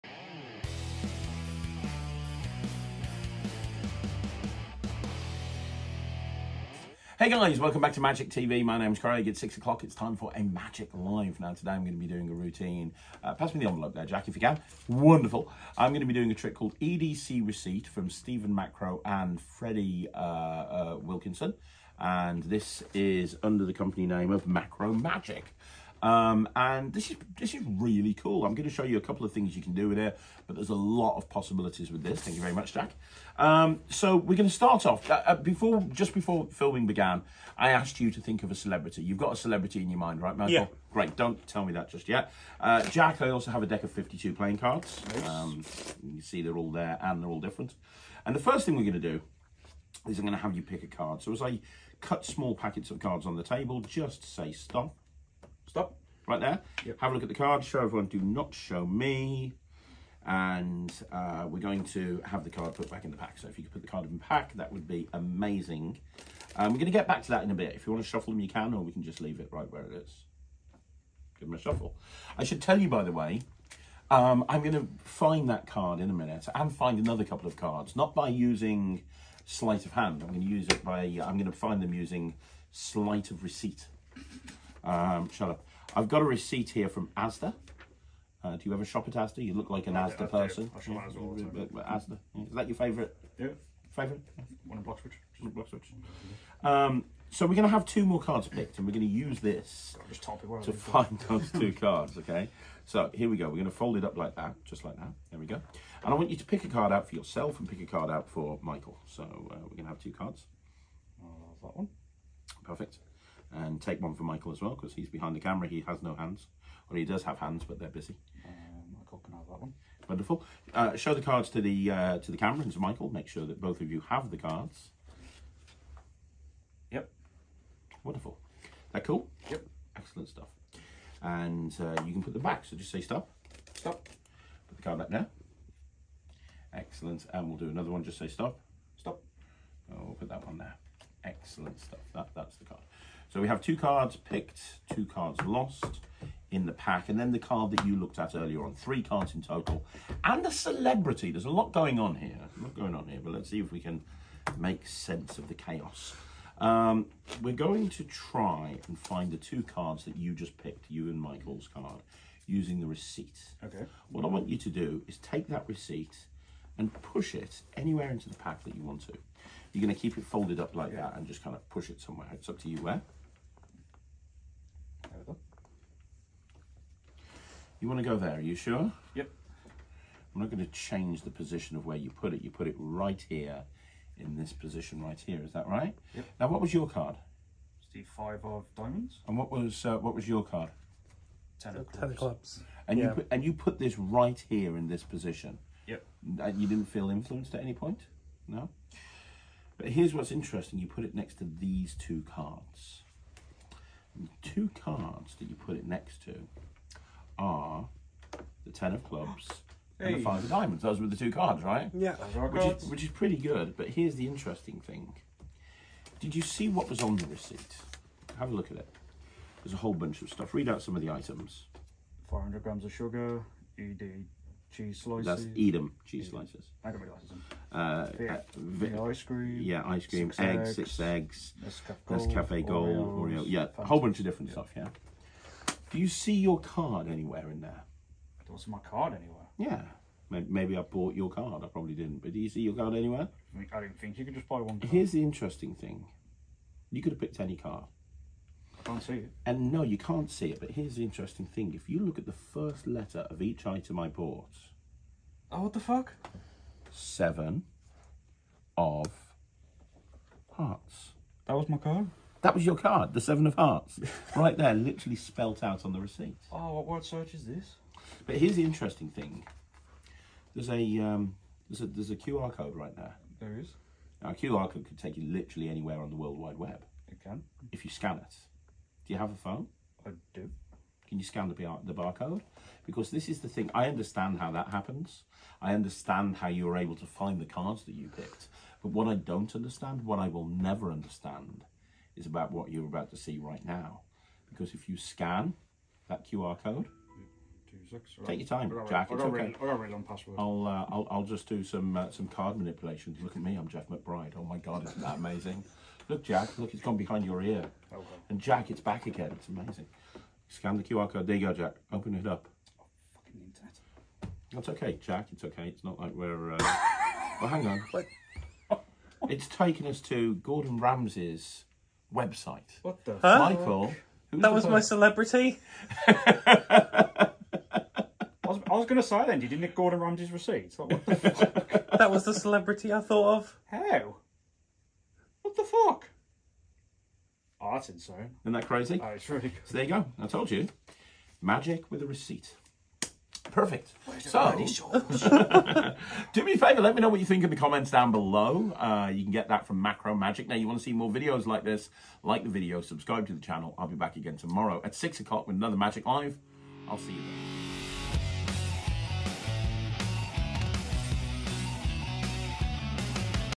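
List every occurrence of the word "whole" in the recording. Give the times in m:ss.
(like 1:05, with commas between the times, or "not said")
3:39, 3:53.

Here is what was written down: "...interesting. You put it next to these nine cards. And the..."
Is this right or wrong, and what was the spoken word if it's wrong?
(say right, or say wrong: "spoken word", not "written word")
wrong: "two", not "nine".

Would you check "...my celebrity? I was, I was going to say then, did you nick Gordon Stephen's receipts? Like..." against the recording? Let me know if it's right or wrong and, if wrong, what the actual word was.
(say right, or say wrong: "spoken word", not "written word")
wrong: "Ramsay", not "Stephen".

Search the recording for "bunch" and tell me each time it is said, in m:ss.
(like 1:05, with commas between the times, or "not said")
3:39, 3:53.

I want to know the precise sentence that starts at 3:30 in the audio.
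Those were the two cards, right?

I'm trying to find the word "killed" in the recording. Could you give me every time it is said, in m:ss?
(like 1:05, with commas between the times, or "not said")
not said.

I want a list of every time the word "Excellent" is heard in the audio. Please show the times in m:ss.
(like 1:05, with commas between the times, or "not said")
2:09, 2:16, 2:21.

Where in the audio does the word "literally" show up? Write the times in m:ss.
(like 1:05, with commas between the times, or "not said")
4:24, 4:35.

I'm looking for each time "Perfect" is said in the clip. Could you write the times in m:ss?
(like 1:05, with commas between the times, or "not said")
1:52, 5:43.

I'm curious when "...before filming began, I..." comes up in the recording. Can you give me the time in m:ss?
0:36.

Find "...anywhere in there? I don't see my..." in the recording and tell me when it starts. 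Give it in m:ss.
3:57.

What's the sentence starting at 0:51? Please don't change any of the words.
So as I cut small packets of cards on the table, just say stop stop right there.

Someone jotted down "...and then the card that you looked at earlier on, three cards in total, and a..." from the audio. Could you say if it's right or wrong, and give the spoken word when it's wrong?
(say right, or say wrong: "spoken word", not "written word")
right.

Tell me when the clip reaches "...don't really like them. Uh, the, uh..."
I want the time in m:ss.
3:46.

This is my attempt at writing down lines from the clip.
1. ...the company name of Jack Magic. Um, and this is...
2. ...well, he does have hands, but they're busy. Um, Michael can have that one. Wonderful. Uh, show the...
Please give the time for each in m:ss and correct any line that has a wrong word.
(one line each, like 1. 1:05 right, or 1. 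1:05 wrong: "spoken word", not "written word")
1. 0:23 wrong: "Macrow", not "Jack"
2. 1:56 right.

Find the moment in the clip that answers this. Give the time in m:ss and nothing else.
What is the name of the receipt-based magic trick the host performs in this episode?
0:16.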